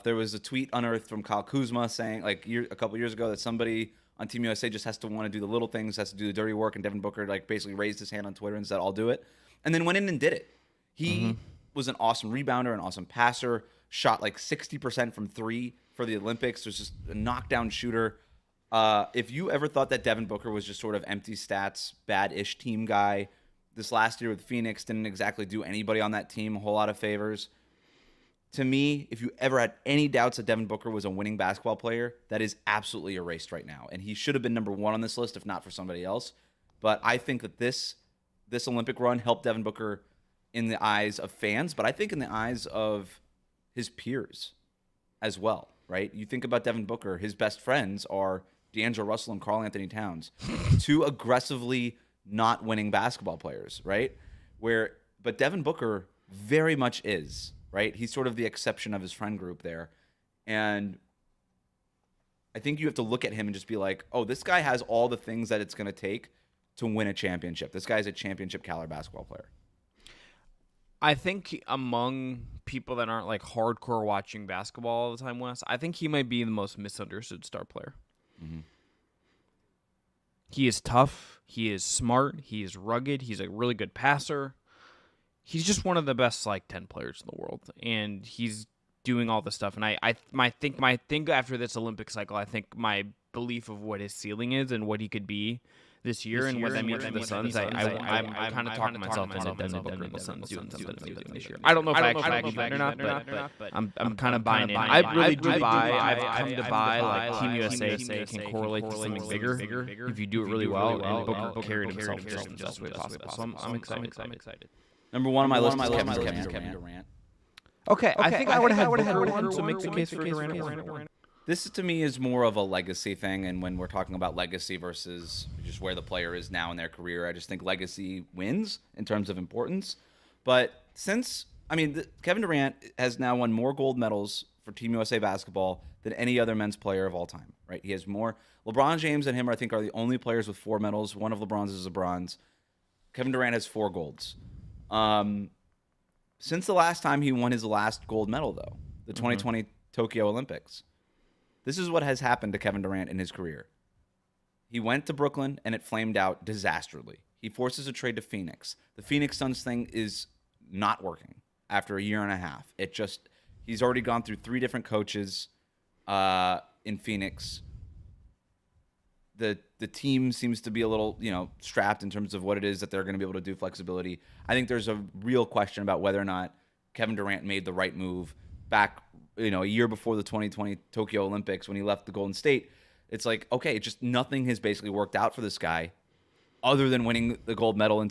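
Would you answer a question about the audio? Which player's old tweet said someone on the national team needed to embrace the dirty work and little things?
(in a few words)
Kyle Kuzma.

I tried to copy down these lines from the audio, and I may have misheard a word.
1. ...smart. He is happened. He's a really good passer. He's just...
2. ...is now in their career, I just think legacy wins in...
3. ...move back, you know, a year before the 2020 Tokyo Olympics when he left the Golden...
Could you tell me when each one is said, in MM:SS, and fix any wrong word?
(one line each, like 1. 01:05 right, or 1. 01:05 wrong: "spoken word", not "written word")
1. 01:21 wrong: "rugged", not "happened"
2. 02:06 right
3. 02:57 right.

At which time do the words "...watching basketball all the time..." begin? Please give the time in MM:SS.
01:14.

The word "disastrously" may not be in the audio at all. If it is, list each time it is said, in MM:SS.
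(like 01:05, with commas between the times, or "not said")
02:36.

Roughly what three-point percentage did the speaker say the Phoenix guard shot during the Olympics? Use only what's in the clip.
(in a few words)
60%.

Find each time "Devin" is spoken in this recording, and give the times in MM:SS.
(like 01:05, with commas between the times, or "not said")
00:06, 00:20, 00:30, 00:39, 00:46, 00:55, 01:39.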